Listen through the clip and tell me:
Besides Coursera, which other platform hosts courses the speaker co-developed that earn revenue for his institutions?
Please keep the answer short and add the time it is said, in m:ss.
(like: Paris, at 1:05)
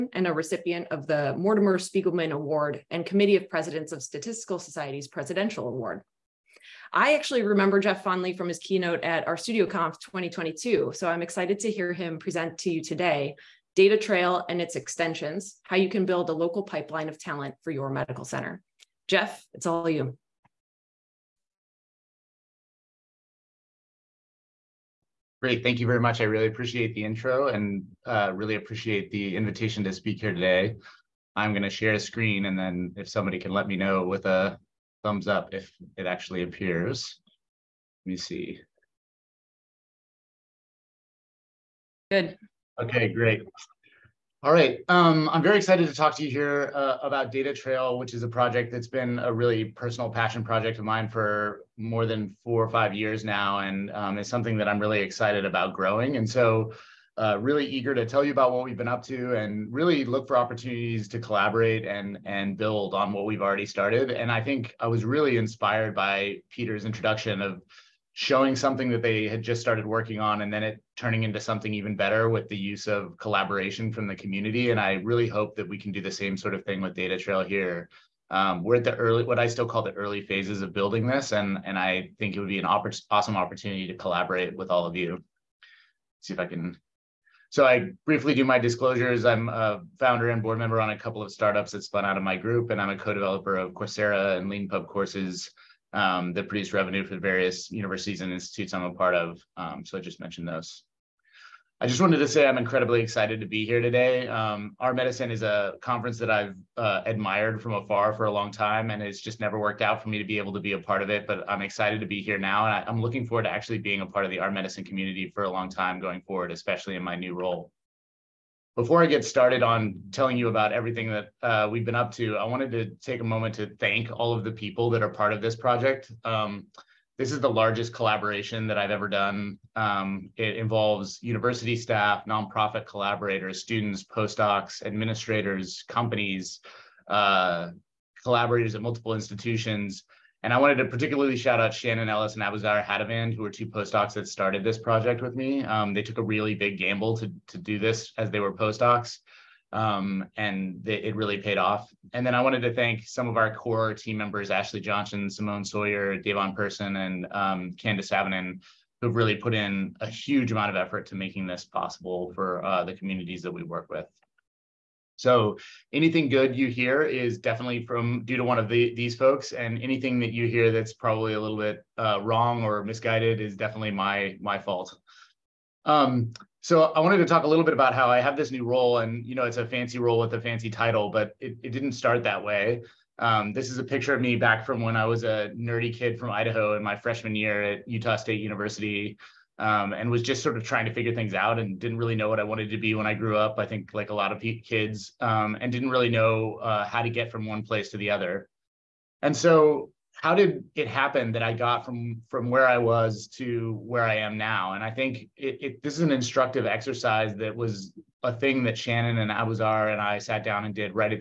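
Leanpub, at 1:34.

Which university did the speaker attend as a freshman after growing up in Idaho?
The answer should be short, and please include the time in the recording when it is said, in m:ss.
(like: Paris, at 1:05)
Utah State University, at 3:07.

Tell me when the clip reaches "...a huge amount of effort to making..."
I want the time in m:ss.
2:40.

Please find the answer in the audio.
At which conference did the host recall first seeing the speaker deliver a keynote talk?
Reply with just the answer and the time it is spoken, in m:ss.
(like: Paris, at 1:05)
RStudio Conf 2022, at 0:09.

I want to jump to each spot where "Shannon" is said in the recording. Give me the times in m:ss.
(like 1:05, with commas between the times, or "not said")
2:21, 3:28.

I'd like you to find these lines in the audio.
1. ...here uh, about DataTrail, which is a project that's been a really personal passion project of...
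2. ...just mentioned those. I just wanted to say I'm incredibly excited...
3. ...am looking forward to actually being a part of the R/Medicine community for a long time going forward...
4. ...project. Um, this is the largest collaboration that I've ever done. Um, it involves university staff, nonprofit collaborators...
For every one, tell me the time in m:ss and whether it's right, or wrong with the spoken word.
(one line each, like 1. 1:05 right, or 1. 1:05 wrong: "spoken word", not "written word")
1. 0:46 right
2. 1:40 right
3. 1:52 right
4. 2:05 right.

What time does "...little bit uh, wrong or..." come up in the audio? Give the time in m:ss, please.
2:51.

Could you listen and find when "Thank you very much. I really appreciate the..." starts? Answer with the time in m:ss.
0:25.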